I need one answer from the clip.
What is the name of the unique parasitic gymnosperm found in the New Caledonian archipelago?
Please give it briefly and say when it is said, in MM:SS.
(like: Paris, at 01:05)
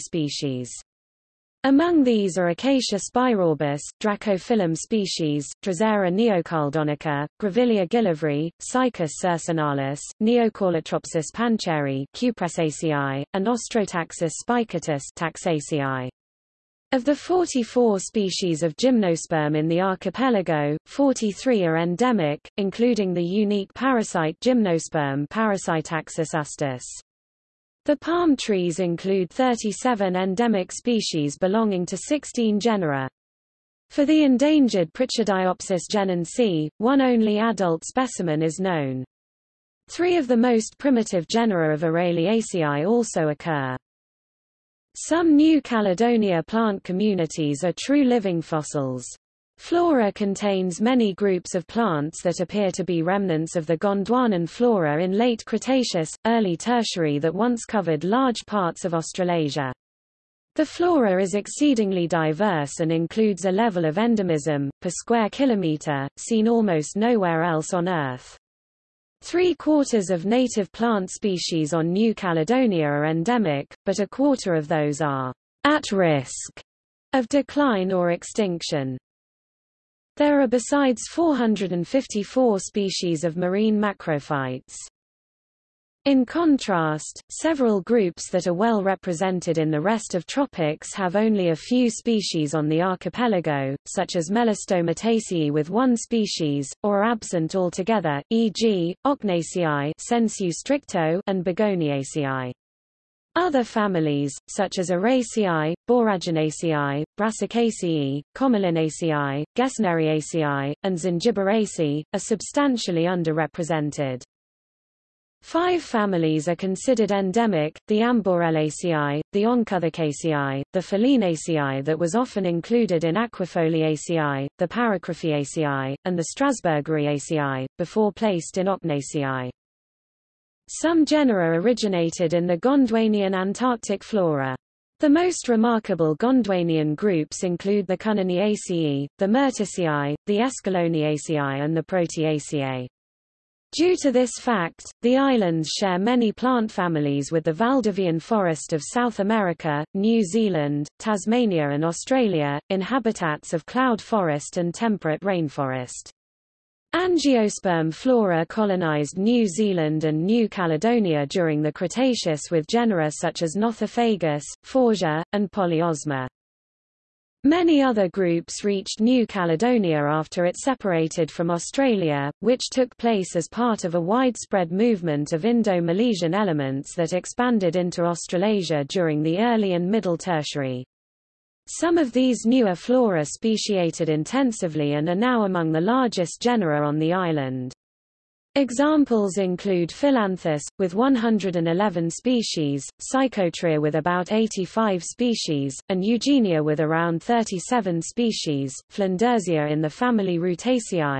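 Parasitaxus astis, at 00:25.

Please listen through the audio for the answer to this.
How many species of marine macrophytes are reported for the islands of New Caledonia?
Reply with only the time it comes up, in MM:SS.
01:21.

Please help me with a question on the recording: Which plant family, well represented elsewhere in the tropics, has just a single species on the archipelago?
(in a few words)
Melastomataceae.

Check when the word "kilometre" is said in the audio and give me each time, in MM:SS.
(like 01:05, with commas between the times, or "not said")
01:05.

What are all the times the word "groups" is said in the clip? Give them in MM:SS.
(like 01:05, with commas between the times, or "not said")
00:51, 01:27, 02:16, 02:48.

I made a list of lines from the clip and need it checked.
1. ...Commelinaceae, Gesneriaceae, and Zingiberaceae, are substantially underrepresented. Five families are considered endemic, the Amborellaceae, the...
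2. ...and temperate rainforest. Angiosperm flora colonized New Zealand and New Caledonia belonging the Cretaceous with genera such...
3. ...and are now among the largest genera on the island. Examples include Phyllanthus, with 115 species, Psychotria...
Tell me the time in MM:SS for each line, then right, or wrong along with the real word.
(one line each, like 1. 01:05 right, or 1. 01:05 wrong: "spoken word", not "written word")
1. 01:48 right
2. 02:34 wrong: "during", not "belonging"
3. 03:04 wrong: "111", not "115".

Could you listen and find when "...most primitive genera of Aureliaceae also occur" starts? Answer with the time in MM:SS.
00:40.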